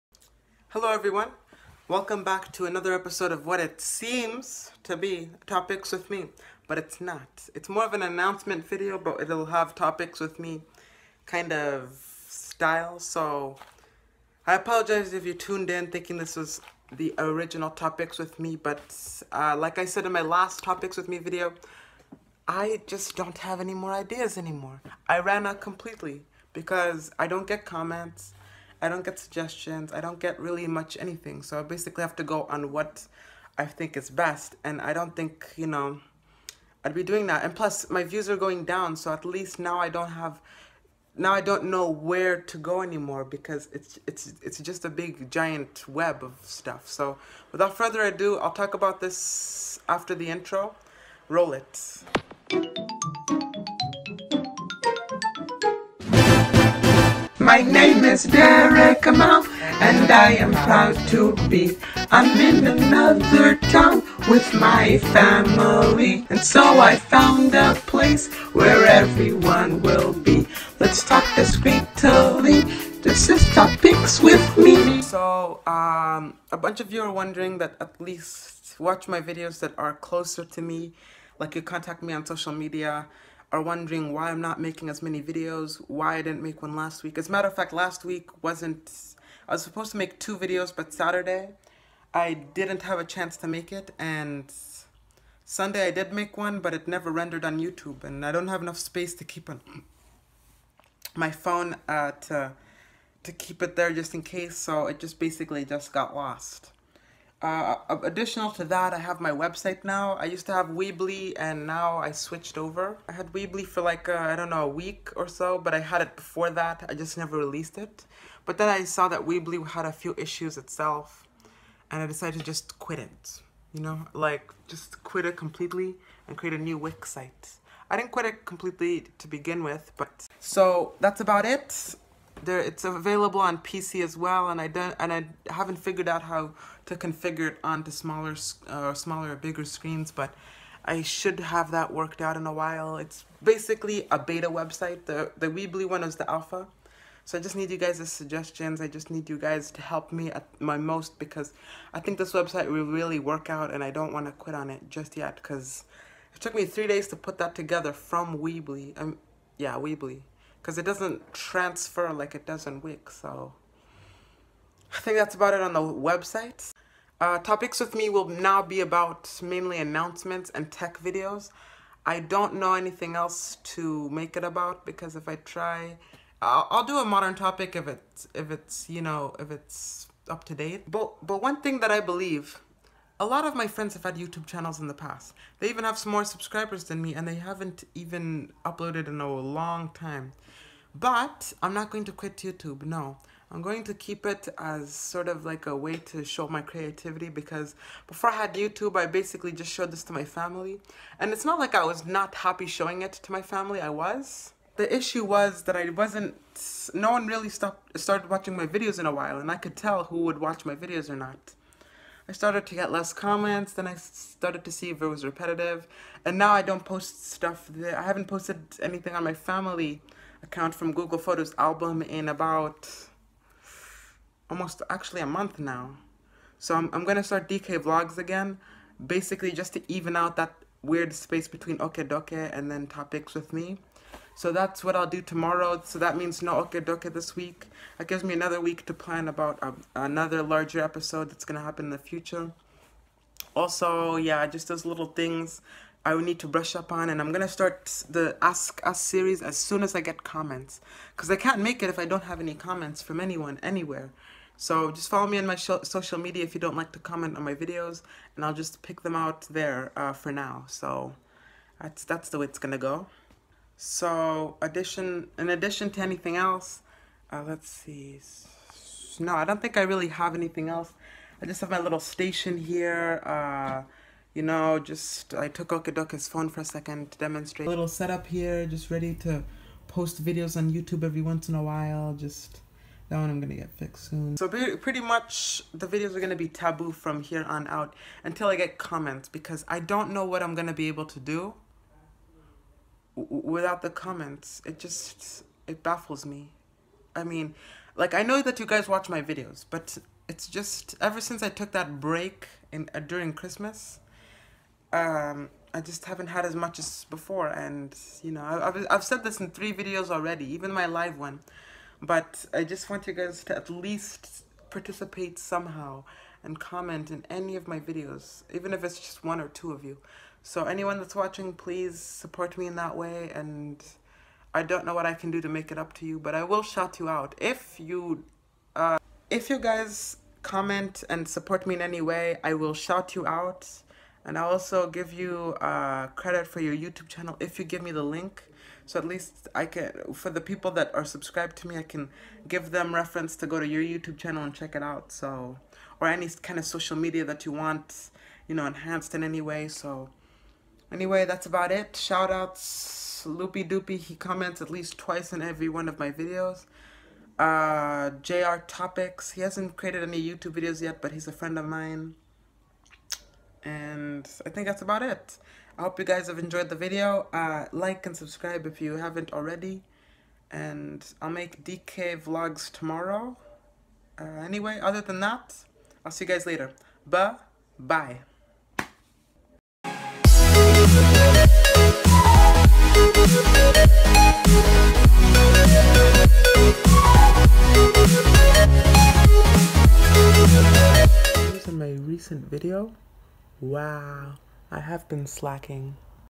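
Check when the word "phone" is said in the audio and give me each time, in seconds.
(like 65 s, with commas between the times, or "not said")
101 s, 276 s.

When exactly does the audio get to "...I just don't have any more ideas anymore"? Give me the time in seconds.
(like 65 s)
22 s.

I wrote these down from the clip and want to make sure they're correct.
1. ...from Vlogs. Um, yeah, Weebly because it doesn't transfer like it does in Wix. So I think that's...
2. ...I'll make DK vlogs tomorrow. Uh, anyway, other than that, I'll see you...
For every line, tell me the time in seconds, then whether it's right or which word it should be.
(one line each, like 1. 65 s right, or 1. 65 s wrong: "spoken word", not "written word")
1. 157 s wrong: "Weebly", not "Vlogs"
2. 371 s right.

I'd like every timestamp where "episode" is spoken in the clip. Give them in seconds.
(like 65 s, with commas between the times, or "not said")
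2 s, 240 s.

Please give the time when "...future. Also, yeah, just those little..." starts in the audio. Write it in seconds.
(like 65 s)
241 s.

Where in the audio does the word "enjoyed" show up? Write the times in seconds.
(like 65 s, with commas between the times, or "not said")
366 s.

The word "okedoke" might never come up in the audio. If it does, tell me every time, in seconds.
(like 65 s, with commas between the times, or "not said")
231 s, 236 s.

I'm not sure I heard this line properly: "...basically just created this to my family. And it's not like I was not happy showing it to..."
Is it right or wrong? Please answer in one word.
wrong.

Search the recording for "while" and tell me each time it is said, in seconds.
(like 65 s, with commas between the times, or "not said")
142 s, 209 s, 281 s.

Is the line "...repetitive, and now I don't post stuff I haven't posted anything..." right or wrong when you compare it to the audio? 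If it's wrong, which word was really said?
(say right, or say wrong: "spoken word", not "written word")
right.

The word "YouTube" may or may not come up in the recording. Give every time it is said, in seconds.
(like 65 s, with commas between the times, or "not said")
97 s, 184 s, 192 s, 198 s, 280 s, 336 s, 343 s, 360 s.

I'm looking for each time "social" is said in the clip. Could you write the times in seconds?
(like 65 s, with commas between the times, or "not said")
82 s, 255 s, 346 s.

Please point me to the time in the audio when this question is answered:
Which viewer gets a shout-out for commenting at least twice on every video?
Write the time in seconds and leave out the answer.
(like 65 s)
353 s.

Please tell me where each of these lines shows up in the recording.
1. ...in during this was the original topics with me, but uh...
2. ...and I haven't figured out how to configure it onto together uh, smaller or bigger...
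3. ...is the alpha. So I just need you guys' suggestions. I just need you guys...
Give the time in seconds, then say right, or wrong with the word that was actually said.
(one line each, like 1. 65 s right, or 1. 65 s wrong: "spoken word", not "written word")
1. 15 s wrong: "thinking", not "during"
2. 134 s wrong: "smaller", not "together"
3. 146 s right.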